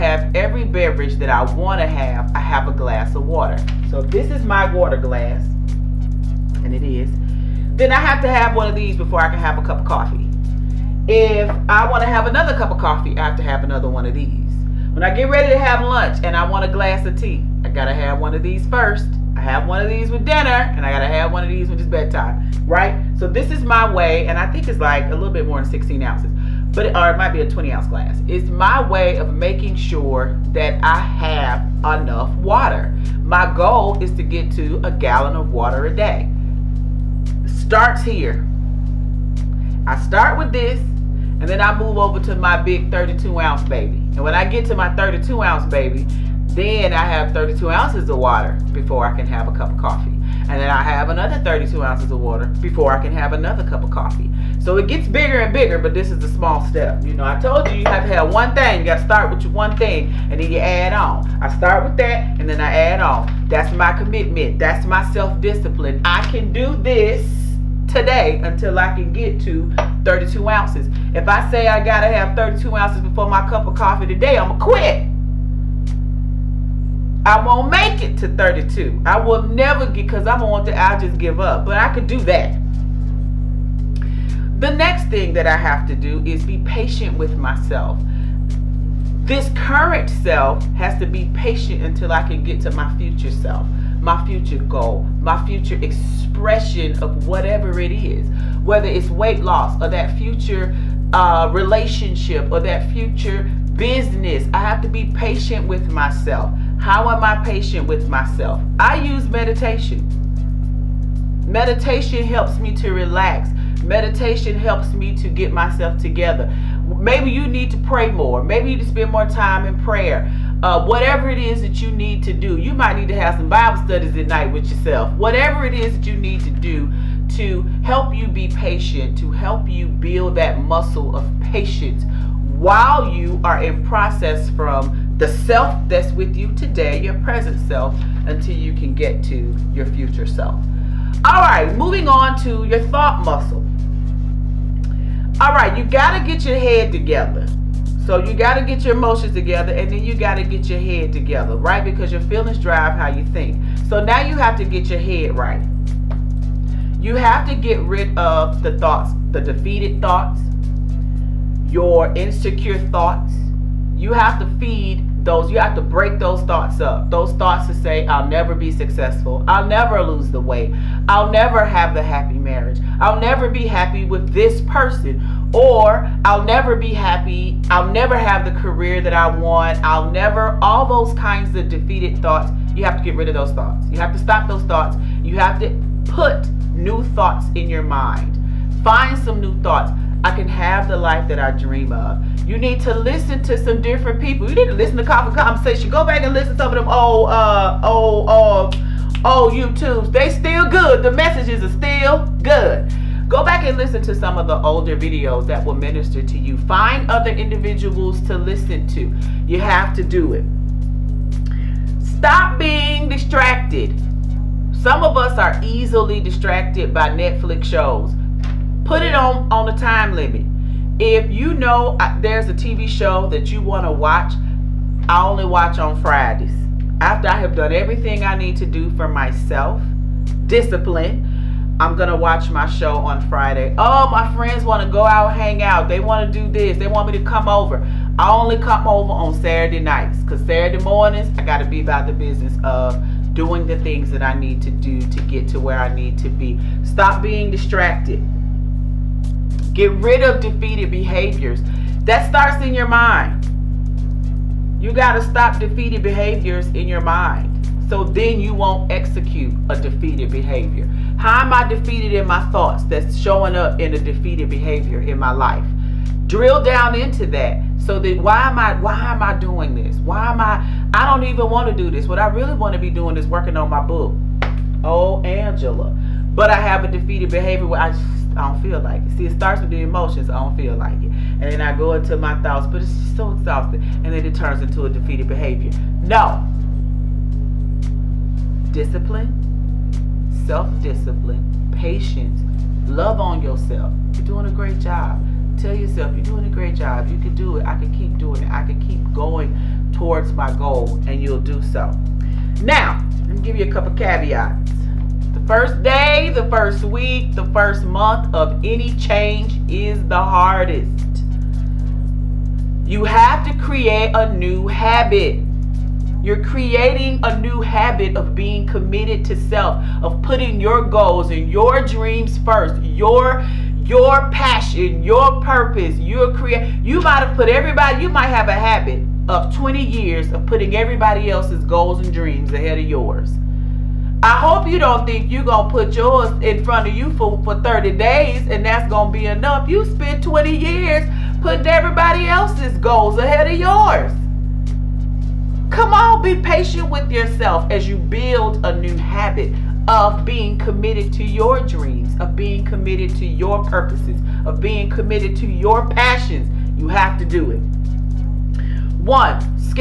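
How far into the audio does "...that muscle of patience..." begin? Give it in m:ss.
2:10.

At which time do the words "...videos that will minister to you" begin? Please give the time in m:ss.
3:24.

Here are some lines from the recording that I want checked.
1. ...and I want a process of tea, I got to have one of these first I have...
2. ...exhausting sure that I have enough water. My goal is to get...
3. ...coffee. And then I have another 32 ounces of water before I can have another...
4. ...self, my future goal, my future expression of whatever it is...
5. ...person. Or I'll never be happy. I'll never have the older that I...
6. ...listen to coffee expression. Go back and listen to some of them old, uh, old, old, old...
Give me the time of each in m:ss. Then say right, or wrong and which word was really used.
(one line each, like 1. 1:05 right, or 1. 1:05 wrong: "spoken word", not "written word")
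1. 0:16 wrong: "glass", not "process"
2. 0:29 wrong: "making", not "exhausting"
3. 0:49 right
4. 1:33 right
5. 2:54 wrong: "career", not "older"
6. 3:14 wrong: "conversation", not "expression".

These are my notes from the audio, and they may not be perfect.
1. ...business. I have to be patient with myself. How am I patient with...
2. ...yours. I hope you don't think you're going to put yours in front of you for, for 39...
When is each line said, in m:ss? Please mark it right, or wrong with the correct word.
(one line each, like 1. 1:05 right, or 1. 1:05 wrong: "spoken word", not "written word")
1. 1:43 right
2. 5:32 wrong: "30", not "39".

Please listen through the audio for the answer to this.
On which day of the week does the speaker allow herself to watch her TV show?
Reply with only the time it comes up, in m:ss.
3:45.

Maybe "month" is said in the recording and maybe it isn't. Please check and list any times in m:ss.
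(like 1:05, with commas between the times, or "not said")
5:07.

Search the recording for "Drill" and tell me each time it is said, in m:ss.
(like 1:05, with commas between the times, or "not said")
4:26.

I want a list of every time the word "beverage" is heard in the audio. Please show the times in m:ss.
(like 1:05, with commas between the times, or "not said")
0:00.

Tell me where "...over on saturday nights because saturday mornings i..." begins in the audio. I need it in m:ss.
3:58.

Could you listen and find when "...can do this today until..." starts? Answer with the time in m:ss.
1:06.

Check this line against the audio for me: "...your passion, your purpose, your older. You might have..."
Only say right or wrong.
wrong.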